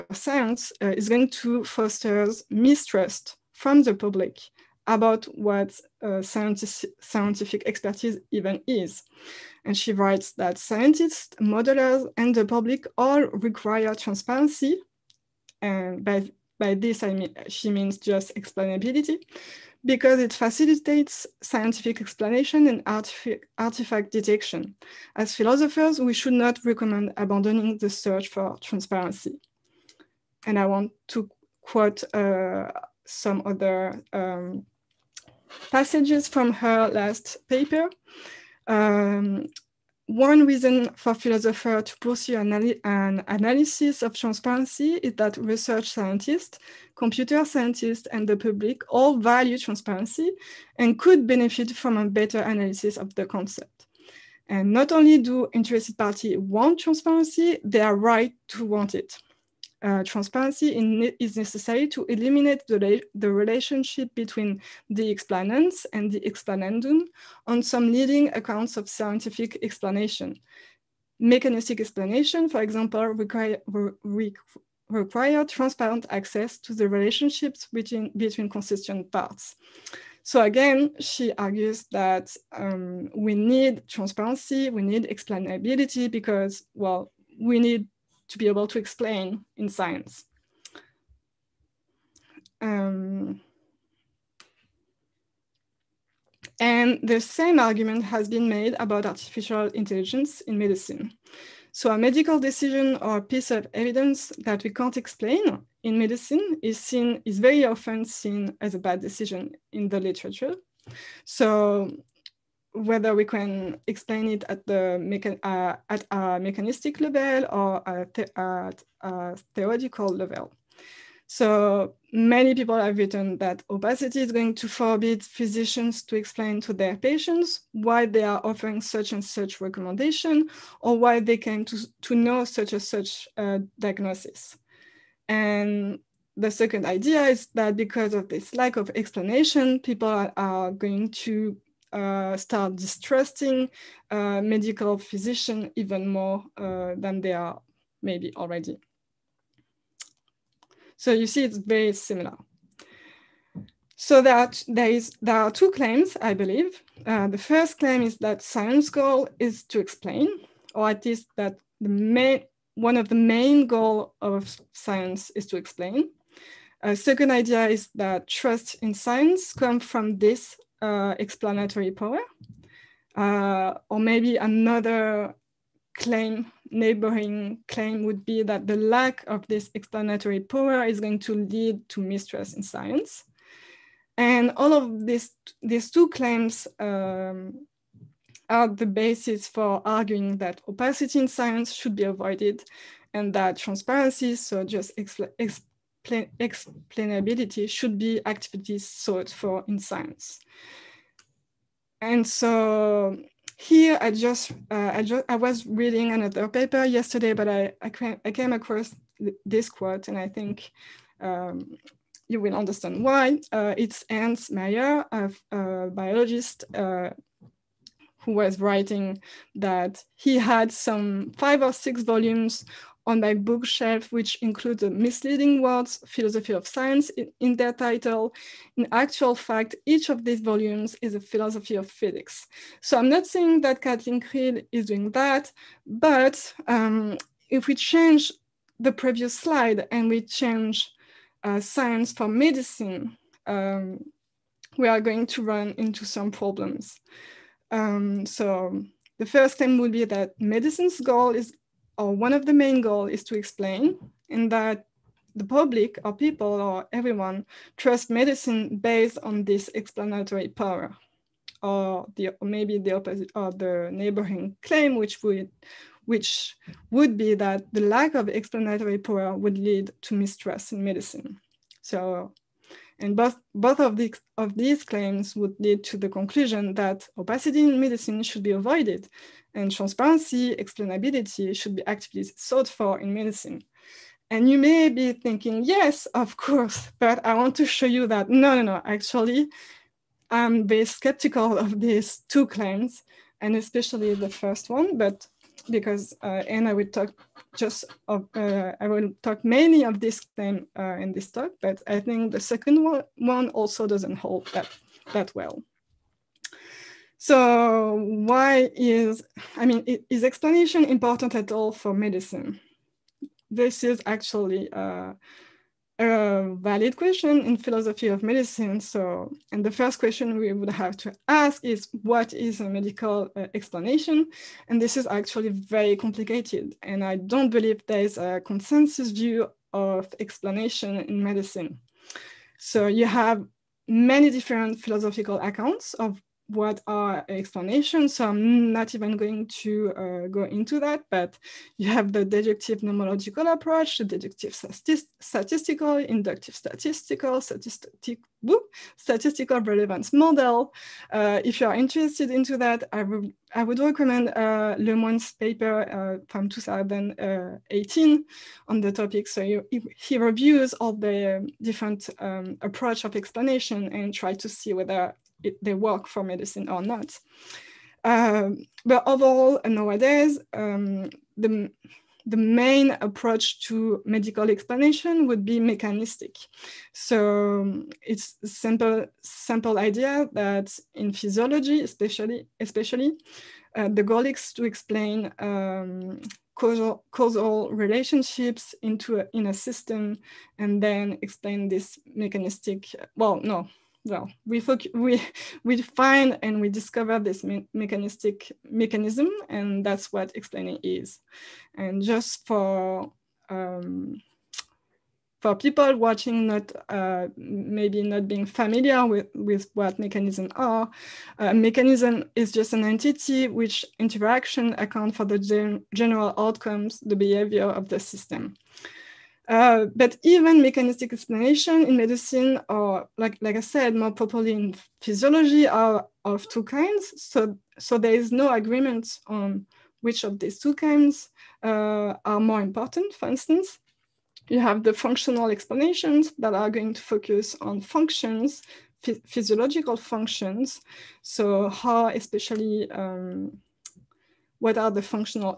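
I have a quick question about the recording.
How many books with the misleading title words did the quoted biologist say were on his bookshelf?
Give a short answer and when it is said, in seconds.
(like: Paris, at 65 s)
5 or 6, at 221 s.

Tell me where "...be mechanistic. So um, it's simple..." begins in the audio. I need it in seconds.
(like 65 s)
375 s.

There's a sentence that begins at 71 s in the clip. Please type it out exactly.
Mechanistic explanation, for example, require, re require transparent access to the relationships between, between consistent parts.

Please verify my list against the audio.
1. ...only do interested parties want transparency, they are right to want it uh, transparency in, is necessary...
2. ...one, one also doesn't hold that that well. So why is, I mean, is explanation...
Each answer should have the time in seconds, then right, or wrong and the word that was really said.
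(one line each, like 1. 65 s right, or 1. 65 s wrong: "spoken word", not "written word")
1. 54 s right
2. 302 s right.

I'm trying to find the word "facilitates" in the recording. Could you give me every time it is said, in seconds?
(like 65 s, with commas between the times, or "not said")
20 s.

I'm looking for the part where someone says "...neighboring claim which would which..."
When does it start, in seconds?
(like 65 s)
263 s.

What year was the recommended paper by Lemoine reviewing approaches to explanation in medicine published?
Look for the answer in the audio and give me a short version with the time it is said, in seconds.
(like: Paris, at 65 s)
2018, at 356 s.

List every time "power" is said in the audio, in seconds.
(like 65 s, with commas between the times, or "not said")
171 s, 180 s, 260 s, 268 s.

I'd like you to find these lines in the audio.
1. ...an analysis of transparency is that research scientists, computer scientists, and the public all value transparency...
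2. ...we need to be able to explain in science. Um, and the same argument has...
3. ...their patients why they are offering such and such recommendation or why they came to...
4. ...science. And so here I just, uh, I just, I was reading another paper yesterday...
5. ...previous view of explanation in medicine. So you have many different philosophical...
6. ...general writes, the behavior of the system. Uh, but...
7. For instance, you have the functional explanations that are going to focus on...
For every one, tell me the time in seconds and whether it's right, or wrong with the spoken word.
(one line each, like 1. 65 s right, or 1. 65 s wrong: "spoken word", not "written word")
1. 42 s right
2. 87 s right
3. 126 s right
4. 199 s right
5. 328 s wrong: "consensus", not "previous"
6. 415 s wrong: "outcomes", not "writes"
7. 433 s right.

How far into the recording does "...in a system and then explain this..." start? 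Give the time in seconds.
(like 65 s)
389 s.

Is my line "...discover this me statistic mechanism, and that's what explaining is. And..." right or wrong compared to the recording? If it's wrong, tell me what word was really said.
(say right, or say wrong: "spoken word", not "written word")
wrong: "mechanistic", not "statistic".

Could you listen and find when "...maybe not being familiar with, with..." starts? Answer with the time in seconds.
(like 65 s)
407 s.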